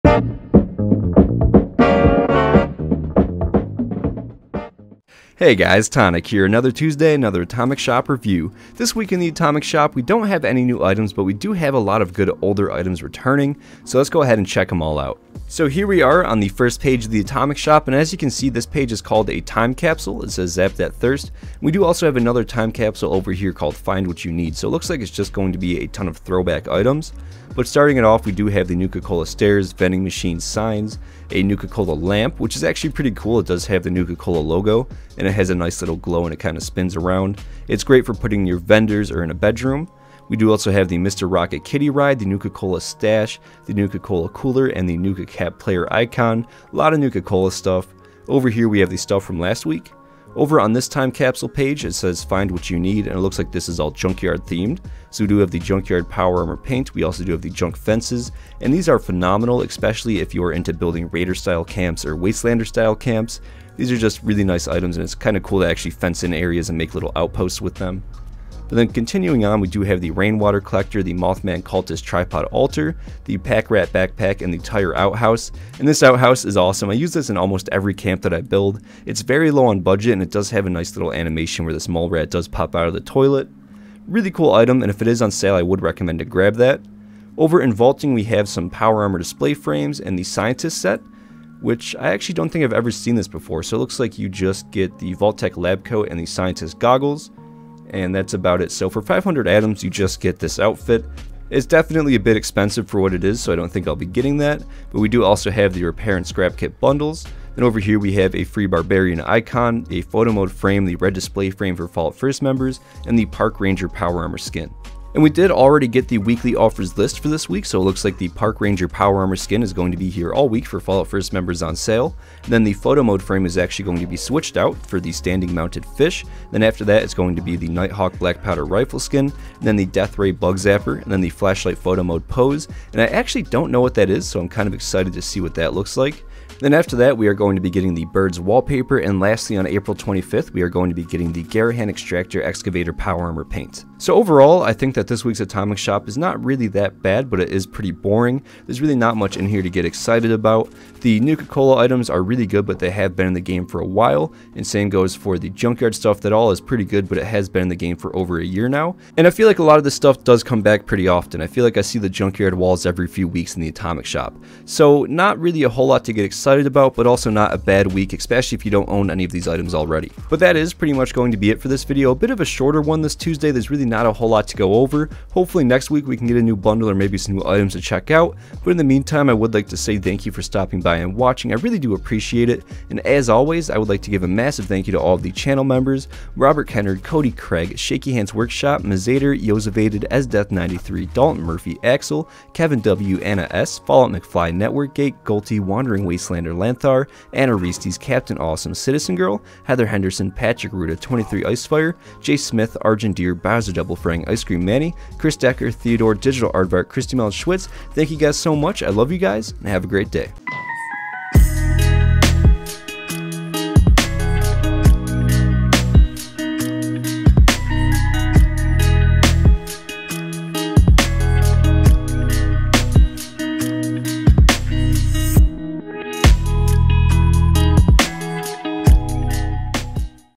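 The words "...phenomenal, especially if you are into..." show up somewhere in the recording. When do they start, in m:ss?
0:58.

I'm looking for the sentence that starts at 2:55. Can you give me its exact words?
Hopefully next week we can get a new bundle or maybe some new items to check out.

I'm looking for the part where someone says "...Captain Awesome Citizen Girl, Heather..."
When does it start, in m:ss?
3:17.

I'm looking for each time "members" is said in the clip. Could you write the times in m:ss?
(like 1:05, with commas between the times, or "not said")
1:52, 2:01, 3:05.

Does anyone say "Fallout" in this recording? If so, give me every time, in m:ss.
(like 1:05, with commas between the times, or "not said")
1:51, 2:00, 3:13.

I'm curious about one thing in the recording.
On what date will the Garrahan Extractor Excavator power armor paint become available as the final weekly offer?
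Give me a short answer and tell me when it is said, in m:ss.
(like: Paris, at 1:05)
April 25th, at 2:19.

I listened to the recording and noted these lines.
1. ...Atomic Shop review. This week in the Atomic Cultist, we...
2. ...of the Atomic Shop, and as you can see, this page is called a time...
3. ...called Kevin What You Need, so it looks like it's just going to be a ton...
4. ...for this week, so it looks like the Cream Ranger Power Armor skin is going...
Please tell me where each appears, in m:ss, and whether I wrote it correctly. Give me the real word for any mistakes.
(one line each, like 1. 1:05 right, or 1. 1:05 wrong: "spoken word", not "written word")
1. 0:07 wrong: "Shop", not "Cultist"
2. 0:17 right
3. 0:23 wrong: "Find", not "Kevin"
4. 1:57 wrong: "Park", not "Cream".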